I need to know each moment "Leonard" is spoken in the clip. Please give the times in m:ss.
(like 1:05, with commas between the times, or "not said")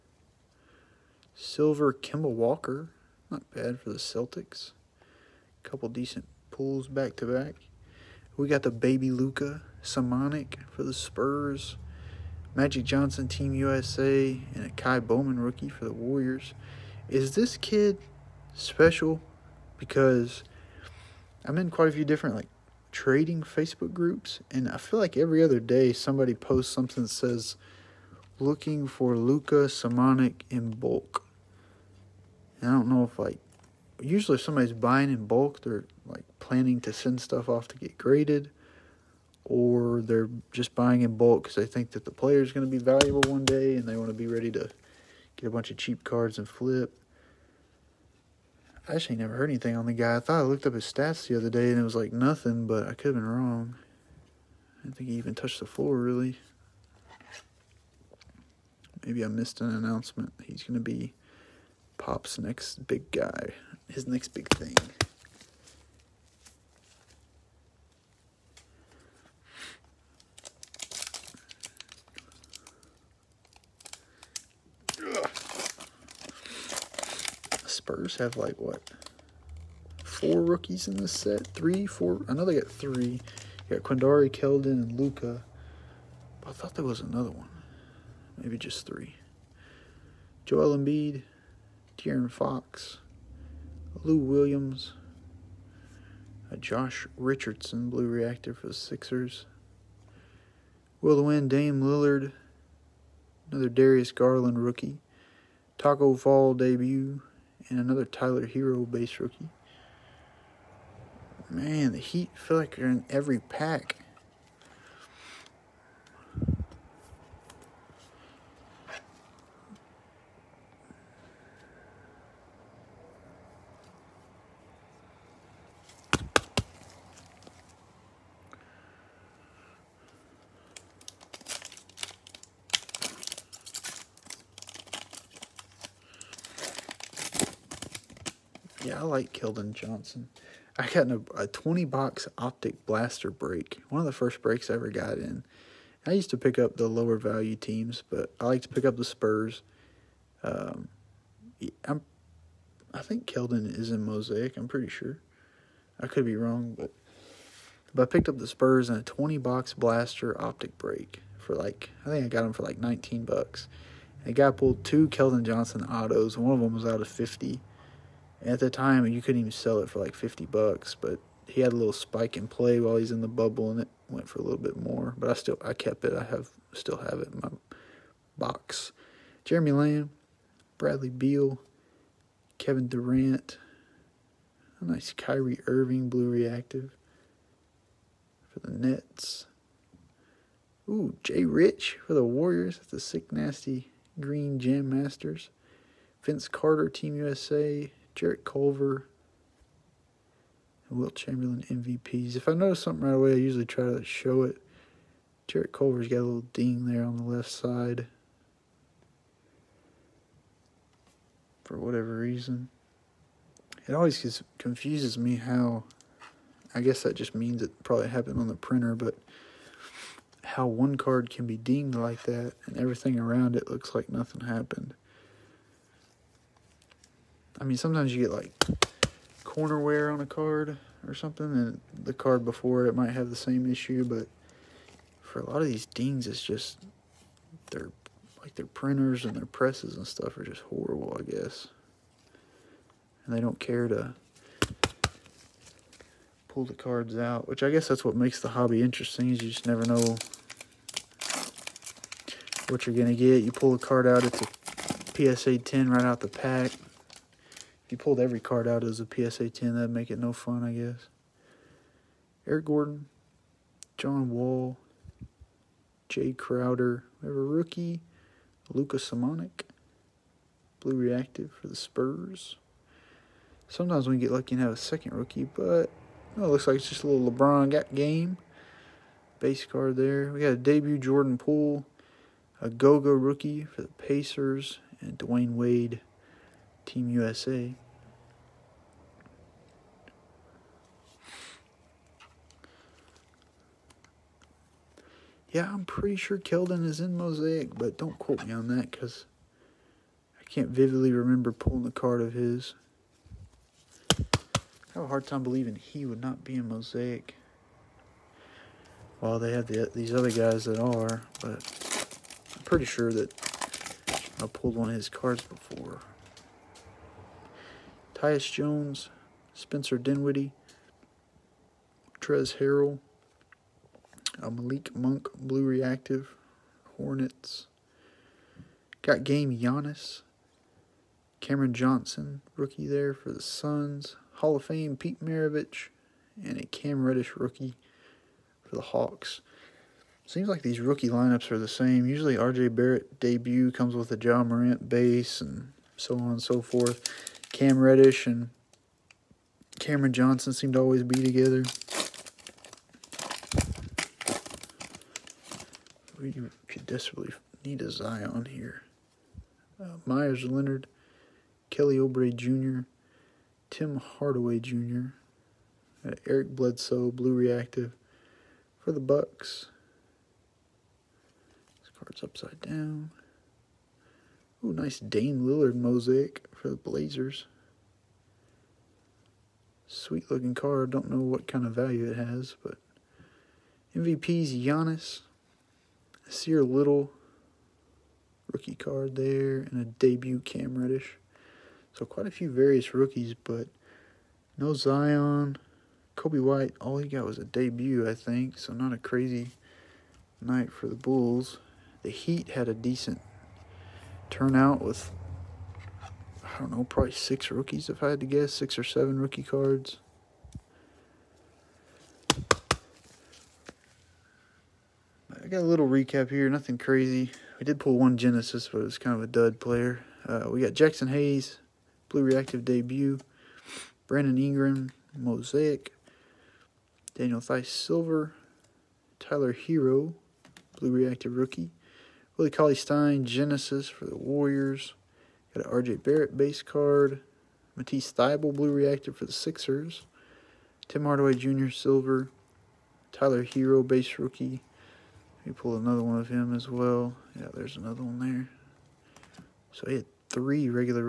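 6:00.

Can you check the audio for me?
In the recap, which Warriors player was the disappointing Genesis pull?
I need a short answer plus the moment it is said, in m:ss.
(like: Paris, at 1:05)
Willie Cauley-Stein, at 7:12.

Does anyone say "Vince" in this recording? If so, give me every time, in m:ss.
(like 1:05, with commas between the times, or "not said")
3:16.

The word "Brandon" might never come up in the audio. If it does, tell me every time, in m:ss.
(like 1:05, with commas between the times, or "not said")
7:04.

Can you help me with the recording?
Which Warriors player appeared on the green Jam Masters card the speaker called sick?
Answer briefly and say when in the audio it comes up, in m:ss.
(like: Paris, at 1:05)
Jay Rich, at 3:11.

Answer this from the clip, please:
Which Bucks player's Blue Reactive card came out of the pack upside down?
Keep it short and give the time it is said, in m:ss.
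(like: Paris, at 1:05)
Eric Bledsoe, at 6:06.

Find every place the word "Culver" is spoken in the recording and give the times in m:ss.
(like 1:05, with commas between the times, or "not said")
3:18, 3:25.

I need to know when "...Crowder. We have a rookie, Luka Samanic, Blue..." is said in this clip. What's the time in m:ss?
4:26.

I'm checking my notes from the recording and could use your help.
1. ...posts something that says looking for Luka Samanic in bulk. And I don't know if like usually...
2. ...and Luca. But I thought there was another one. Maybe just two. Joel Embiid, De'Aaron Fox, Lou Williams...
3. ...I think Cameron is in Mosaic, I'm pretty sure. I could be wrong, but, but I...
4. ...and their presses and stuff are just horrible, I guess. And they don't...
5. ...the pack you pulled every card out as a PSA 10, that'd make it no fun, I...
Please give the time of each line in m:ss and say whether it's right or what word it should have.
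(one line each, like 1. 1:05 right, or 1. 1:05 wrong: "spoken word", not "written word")
1. 0:26 right
2. 1:24 wrong: "three", not "two"
3. 2:32 wrong: "Keldon", not "Cameron"
4. 3:59 right
5. 4:16 right.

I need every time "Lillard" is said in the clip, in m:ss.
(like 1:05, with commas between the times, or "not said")
1:41, 6:15.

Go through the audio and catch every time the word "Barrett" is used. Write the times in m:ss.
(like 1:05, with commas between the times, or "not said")
5:42, 7:16.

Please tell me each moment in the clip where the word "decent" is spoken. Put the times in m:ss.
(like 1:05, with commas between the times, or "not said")
0:05, 6:42.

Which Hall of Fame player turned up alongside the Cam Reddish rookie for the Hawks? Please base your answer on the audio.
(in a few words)
Pete Maravich.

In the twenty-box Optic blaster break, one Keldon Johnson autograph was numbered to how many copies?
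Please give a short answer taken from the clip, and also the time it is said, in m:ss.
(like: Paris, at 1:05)
50, at 2:46.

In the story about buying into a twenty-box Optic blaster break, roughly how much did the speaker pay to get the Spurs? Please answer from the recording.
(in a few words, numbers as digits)
$19.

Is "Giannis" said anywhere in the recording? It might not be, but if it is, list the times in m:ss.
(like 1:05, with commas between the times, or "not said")
5:29, 6:24.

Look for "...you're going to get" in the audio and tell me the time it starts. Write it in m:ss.
4:12.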